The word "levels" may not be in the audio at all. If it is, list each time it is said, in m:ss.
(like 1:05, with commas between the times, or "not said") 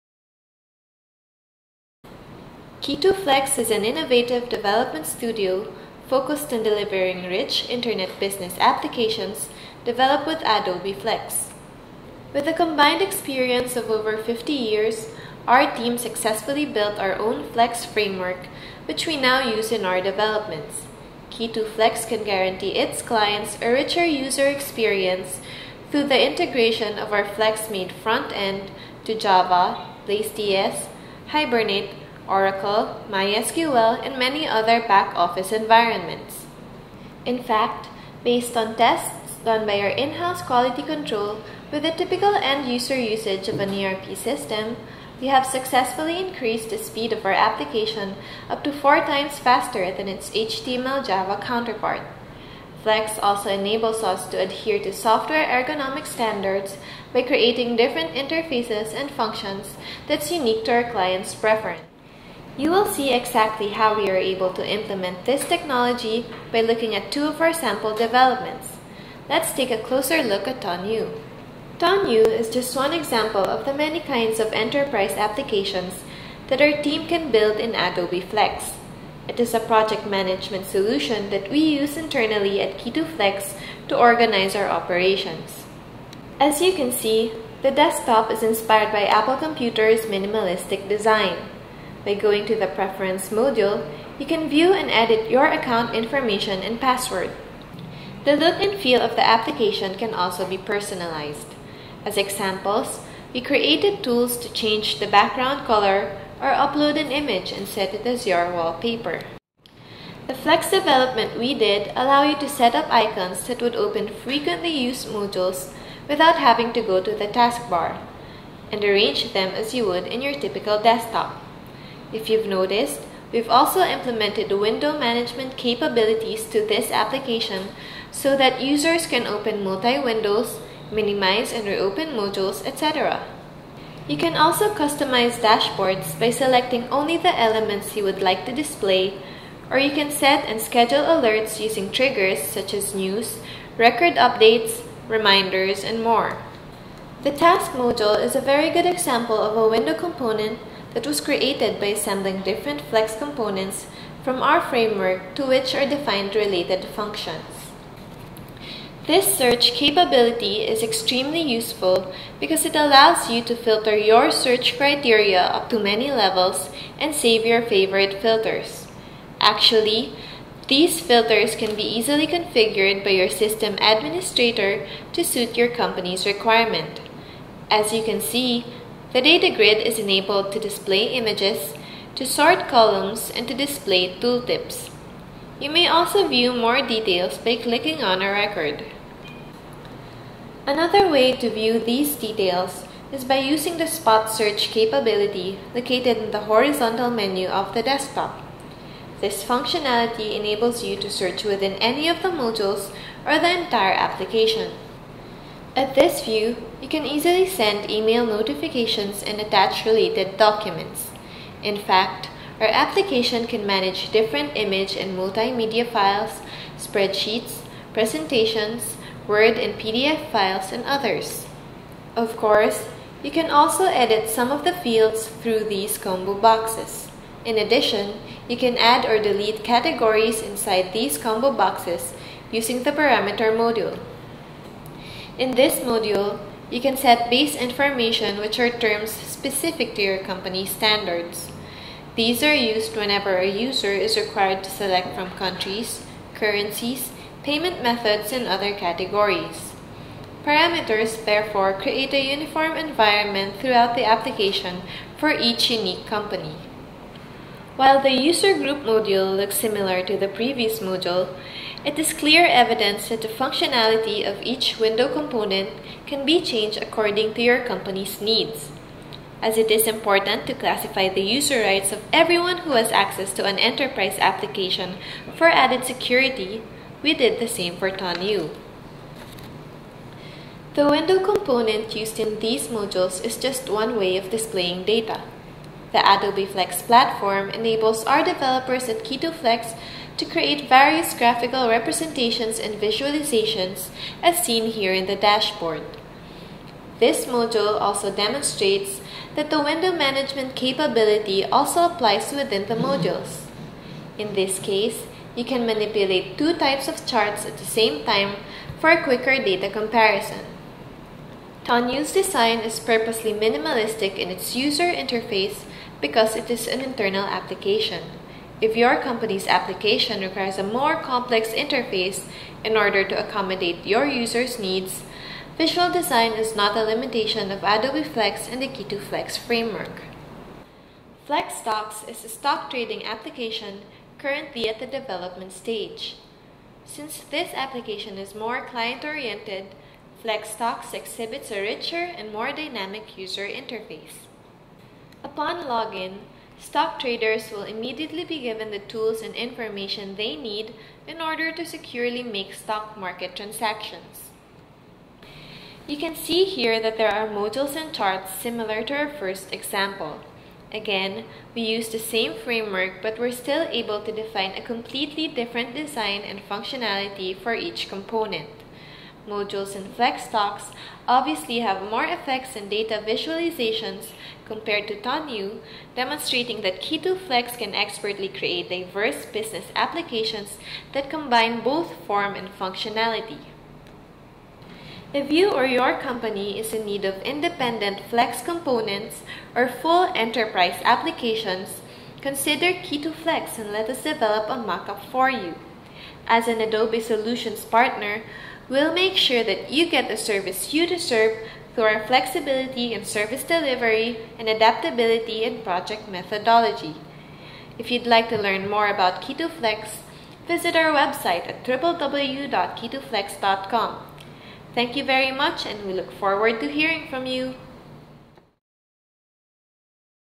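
2:46.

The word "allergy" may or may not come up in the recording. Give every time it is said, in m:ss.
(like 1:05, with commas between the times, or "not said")
not said.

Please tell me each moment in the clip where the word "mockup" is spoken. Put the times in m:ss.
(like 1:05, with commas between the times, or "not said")
6:34.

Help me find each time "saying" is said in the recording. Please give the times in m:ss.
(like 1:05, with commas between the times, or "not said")
not said.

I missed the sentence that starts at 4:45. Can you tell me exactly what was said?
The Adobe Flex platform enables our developers at Key2Flex to create various graphical representations and visualizations as seen here in the dashboard.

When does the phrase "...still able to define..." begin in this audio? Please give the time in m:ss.
6:03.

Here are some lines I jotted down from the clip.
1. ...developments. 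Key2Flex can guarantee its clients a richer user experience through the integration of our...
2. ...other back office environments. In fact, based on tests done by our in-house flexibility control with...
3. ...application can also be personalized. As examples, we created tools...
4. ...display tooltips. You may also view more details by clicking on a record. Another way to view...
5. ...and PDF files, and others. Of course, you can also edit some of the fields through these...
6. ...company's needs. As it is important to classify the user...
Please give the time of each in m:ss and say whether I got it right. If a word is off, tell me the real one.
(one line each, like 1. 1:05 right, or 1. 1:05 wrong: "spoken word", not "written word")
1. 0:20 right
2. 0:34 wrong: "quality", not "flexibility"
3. 1:39 right
4. 3:03 right
5. 3:39 right
6. 4:27 right.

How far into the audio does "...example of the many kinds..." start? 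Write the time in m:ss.
1:12.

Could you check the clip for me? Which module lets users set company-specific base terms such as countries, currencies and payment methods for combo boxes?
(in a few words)
parameter module.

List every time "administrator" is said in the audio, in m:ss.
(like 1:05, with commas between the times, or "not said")
2:53.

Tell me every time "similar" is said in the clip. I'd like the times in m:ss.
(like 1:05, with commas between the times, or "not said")
4:19, 5:58.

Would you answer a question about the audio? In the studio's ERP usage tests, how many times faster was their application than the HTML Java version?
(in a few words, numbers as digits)
4.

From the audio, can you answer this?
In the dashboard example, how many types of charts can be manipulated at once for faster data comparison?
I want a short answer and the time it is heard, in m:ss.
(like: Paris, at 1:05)
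2, at 5:06.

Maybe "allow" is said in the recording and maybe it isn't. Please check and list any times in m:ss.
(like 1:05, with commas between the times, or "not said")
1:51, 2:42.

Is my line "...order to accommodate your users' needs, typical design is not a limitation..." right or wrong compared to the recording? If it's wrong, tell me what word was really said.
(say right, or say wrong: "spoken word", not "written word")
wrong: "visual", not "typical".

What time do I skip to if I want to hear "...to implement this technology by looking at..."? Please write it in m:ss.
1:04.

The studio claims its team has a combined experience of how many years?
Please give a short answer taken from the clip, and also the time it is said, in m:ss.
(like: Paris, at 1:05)
50, at 0:13.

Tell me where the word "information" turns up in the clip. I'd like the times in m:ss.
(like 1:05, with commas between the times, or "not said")
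1:35, 3:57, 5:49.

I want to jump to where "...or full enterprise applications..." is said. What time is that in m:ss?
6:29.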